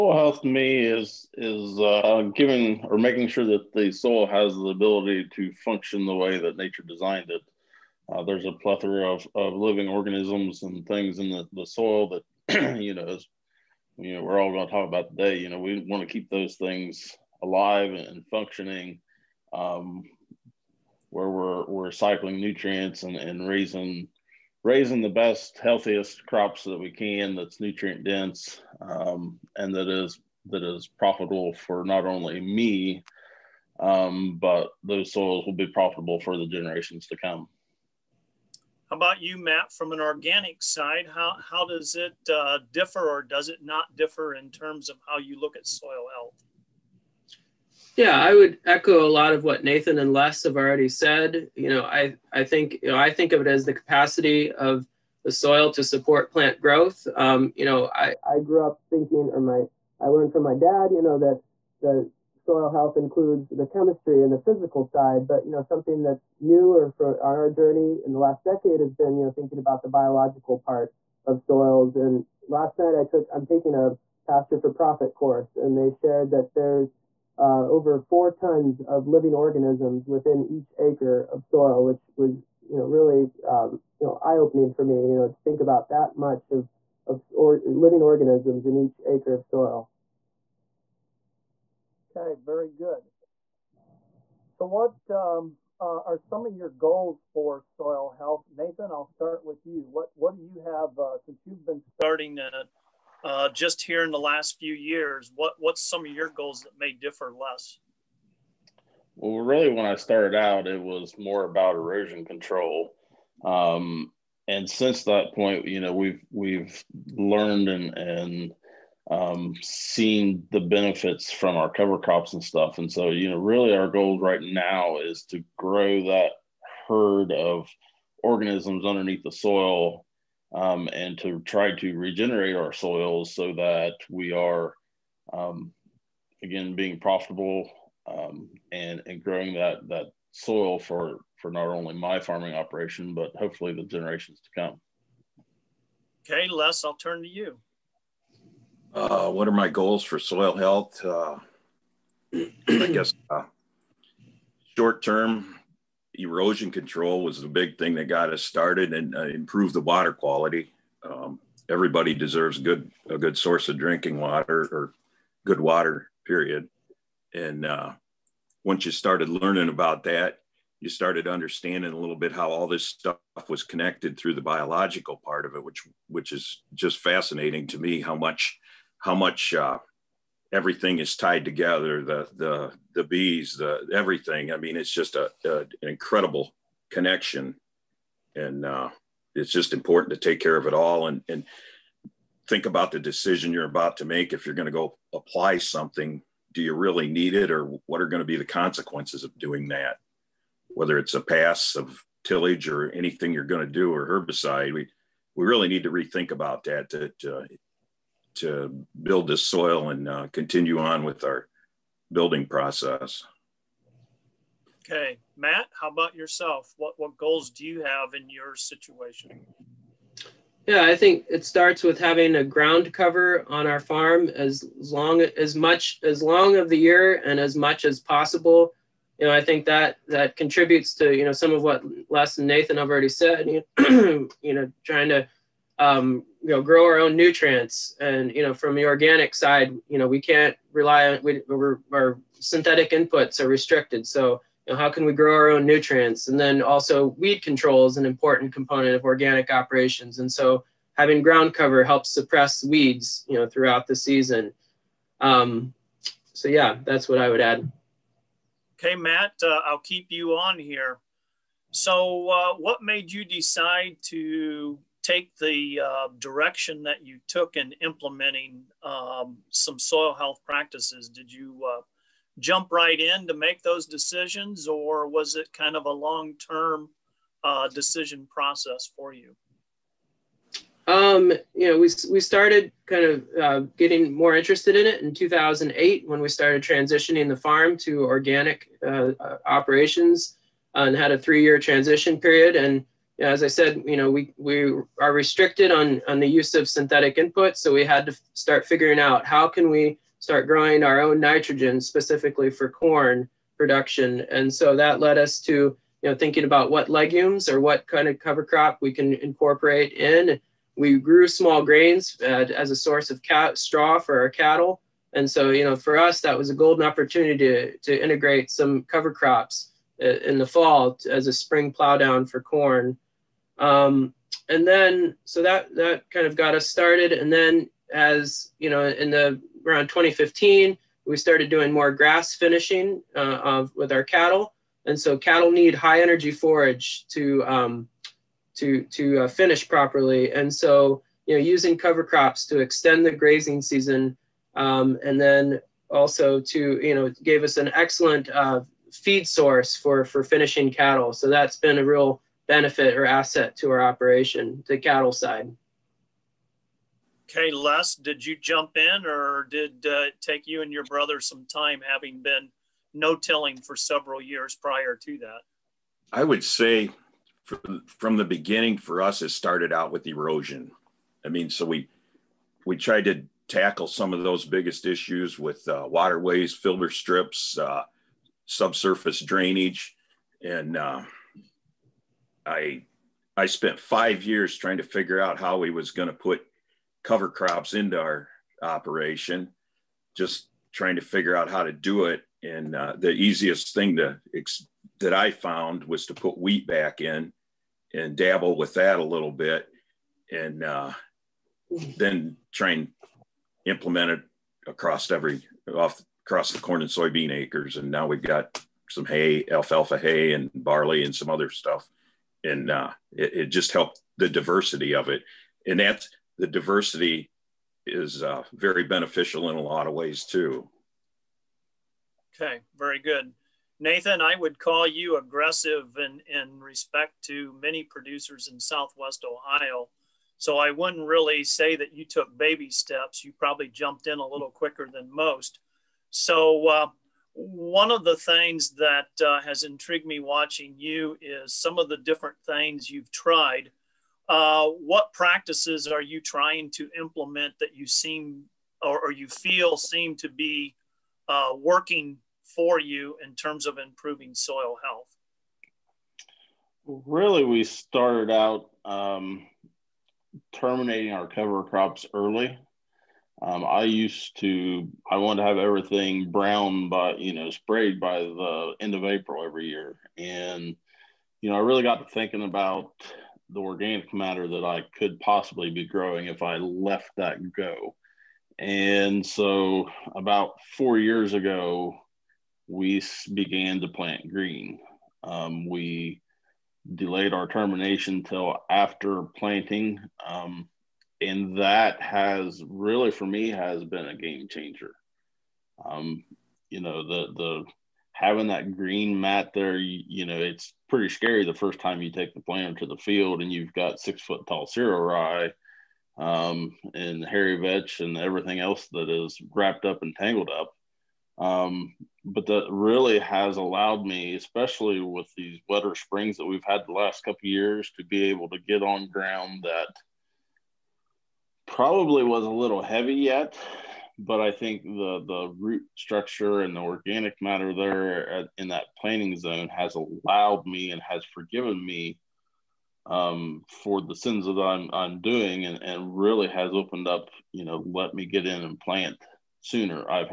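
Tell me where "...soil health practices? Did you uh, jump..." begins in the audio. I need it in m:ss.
4:29.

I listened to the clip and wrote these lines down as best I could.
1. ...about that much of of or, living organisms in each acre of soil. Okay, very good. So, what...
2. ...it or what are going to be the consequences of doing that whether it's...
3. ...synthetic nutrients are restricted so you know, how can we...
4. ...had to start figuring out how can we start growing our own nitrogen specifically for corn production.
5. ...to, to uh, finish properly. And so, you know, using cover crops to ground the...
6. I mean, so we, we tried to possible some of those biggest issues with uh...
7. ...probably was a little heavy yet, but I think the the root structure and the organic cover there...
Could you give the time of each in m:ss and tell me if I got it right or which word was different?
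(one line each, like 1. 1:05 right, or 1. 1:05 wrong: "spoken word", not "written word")
1. 1:25 right
2. 3:17 right
3. 4:02 wrong: "inputs", not "nutrients"
4. 4:57 right
5. 5:38 wrong: "extend", not "ground"
6. 6:11 wrong: "tackle", not "possible"
7. 8:41 wrong: "matter", not "cover".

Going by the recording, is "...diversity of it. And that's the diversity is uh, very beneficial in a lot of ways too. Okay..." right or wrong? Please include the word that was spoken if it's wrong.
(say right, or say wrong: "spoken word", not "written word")
right.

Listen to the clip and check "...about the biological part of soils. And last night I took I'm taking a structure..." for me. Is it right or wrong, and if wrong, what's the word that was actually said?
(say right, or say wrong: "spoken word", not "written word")
wrong: "pasture", not "structure".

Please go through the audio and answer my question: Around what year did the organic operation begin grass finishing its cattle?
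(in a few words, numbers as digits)
2015.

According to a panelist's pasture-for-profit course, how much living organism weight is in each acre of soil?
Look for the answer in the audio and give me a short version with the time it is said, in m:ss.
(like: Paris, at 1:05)
over 4 tons, at 1:17.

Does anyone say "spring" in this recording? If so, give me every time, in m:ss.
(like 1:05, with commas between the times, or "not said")
5:21, 8:35.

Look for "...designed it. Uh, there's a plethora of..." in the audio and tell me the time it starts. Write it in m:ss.
0:06.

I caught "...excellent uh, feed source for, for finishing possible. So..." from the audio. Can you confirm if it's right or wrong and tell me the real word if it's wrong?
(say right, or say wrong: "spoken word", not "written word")
wrong: "cattle", not "possible".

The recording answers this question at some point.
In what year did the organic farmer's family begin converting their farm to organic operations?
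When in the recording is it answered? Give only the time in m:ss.
4:45.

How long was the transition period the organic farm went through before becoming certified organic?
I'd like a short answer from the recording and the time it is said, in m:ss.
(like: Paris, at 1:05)
3 years, at 4:51.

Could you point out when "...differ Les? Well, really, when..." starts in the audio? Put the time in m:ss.
1:46.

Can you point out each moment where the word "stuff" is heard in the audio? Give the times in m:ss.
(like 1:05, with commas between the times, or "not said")
2:02, 2:52, 6:51.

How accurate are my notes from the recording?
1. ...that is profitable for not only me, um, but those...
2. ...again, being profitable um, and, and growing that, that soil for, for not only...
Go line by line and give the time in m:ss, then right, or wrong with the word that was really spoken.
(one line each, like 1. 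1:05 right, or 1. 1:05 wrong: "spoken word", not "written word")
1. 0:30 right
2. 2:16 right.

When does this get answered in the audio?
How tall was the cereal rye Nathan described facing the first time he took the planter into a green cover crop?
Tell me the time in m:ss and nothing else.
8:23.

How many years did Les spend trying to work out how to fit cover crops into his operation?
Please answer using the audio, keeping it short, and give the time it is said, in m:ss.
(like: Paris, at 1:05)
5 years, at 6:23.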